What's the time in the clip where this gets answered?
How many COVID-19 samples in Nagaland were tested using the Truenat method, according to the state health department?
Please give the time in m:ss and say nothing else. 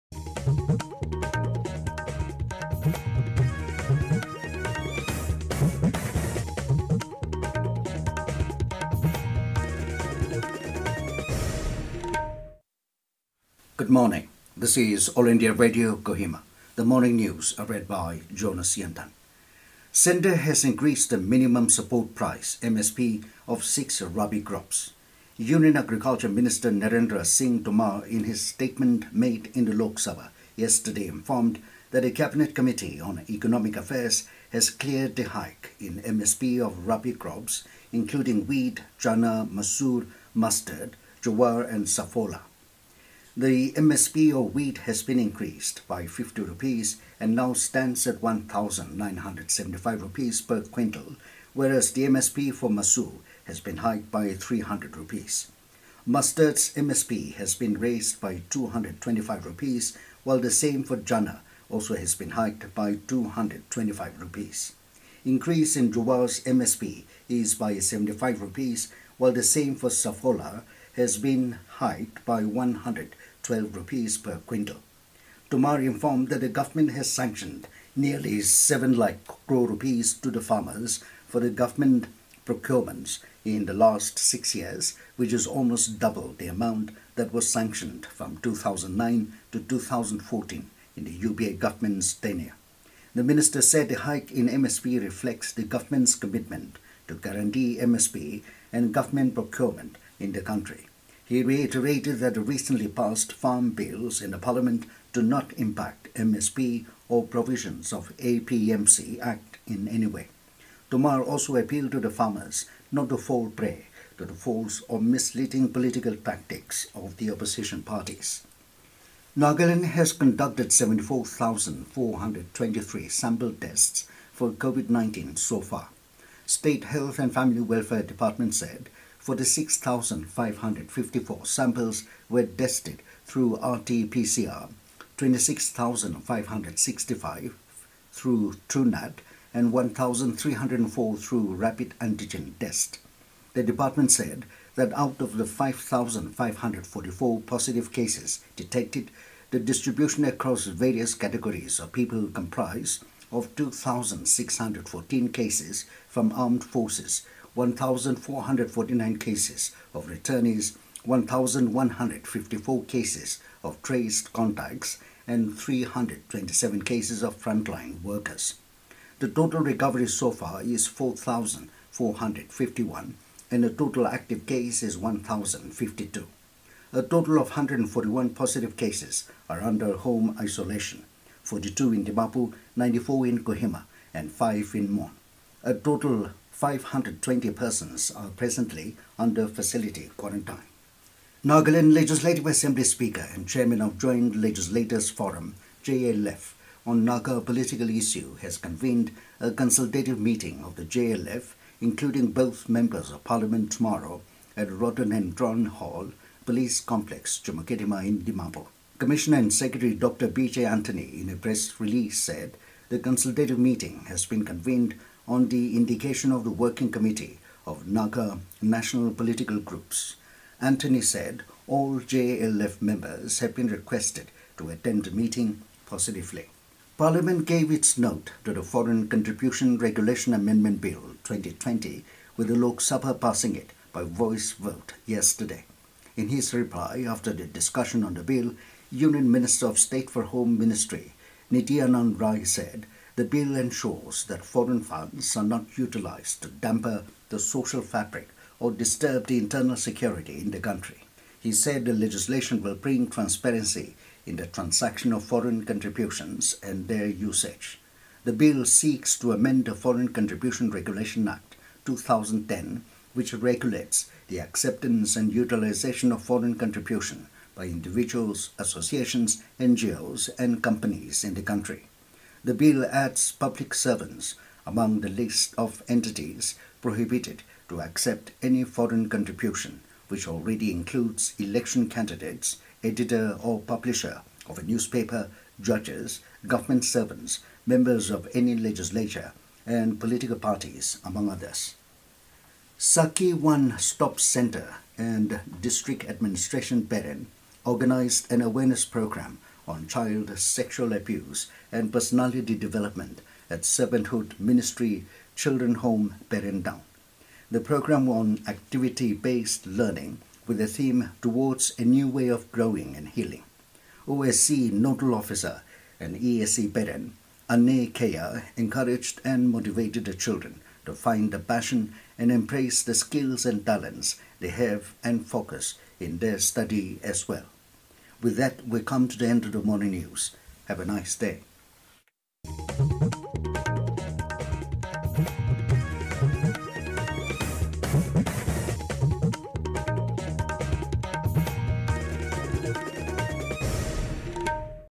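2:15.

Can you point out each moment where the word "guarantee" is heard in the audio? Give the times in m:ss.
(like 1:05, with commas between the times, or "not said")
1:37.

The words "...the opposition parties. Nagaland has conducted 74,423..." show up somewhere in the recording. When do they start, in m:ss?
1:57.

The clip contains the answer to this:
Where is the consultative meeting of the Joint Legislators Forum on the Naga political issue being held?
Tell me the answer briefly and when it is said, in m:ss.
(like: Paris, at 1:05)
Police Complex, Chumukedima, at 3:26.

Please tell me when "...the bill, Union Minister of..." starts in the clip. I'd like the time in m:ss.
3:58.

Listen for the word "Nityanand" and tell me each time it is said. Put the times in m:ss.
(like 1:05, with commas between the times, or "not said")
4:01.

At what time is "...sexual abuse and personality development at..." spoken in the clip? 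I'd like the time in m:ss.
5:00.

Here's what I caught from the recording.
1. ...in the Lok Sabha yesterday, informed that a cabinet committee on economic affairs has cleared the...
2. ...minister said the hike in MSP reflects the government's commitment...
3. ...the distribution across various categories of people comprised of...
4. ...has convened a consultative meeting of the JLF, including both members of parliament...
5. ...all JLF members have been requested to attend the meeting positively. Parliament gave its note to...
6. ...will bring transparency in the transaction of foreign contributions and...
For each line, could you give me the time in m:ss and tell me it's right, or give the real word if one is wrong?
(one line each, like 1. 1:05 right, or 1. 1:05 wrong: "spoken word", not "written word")
1. 0:29 right
2. 1:33 right
3. 2:29 right
4. 3:18 right
5. 3:41 right
6. 4:12 right.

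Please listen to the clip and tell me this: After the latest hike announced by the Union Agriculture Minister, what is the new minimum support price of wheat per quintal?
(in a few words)
1,975 rupees.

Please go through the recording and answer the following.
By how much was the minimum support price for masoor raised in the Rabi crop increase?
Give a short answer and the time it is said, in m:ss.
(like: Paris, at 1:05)
300 rupees, at 0:54.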